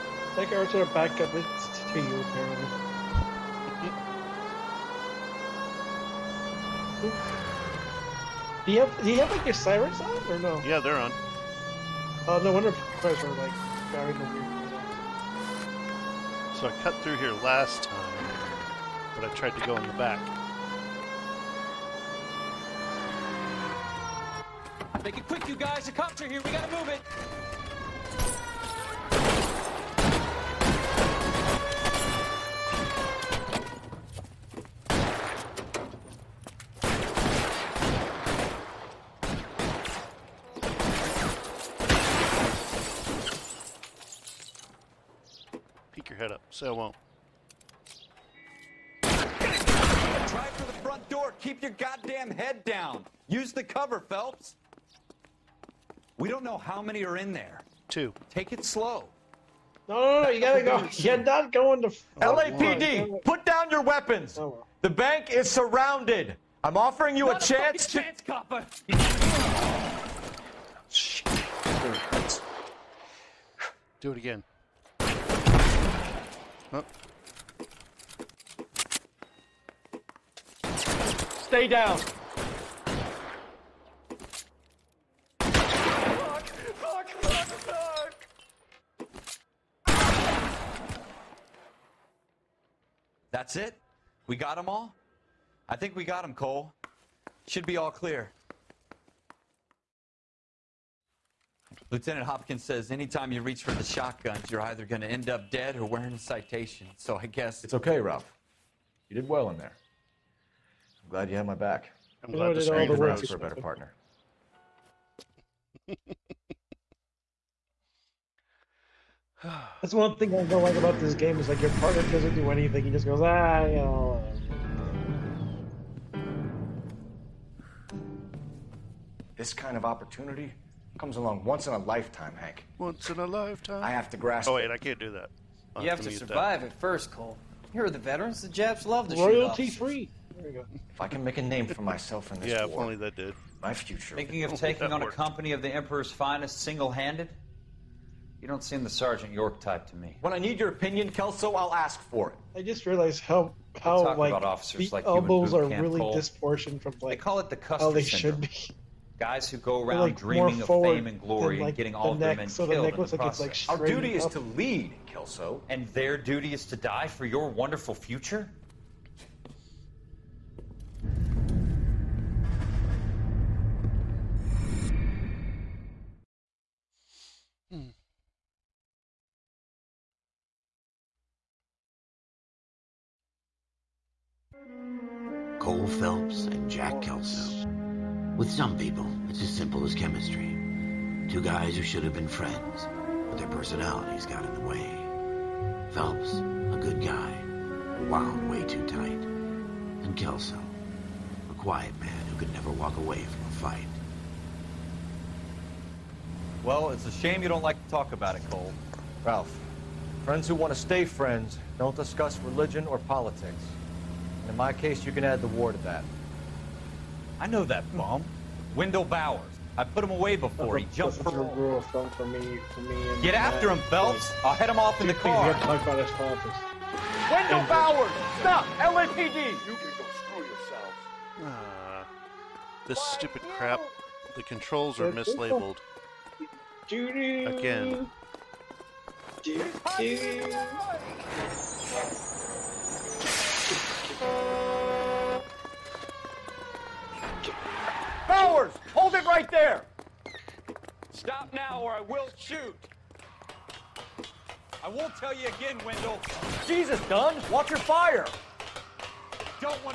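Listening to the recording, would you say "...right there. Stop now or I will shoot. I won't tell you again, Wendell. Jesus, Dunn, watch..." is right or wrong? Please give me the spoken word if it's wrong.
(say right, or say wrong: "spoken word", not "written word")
right.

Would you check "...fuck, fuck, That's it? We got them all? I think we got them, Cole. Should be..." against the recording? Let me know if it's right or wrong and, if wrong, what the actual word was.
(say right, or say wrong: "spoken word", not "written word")
right.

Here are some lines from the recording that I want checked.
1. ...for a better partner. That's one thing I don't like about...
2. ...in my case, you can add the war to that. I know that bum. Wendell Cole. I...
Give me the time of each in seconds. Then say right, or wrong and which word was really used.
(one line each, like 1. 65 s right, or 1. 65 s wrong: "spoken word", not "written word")
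1. 113 s right
2. 214 s wrong: "Bowers", not "Cole".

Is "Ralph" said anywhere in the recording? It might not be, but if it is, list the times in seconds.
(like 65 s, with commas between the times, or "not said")
107 s, 209 s.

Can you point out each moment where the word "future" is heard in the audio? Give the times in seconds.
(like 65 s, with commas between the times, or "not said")
143 s, 167 s.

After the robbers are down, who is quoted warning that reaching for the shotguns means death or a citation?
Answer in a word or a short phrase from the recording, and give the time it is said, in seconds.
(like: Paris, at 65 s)
Lieutenant Hopkins, at 101 s.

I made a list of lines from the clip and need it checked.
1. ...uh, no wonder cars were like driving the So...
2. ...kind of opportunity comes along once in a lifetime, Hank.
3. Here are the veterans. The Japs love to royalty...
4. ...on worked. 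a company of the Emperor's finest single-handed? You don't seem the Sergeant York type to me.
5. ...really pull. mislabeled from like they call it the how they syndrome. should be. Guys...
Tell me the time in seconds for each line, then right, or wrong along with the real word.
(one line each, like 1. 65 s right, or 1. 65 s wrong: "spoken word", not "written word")
1. 12 s right
2. 129 s right
3. 137 s right
4. 144 s right
5. 155 s wrong: "disproportioned", not "mislabeled".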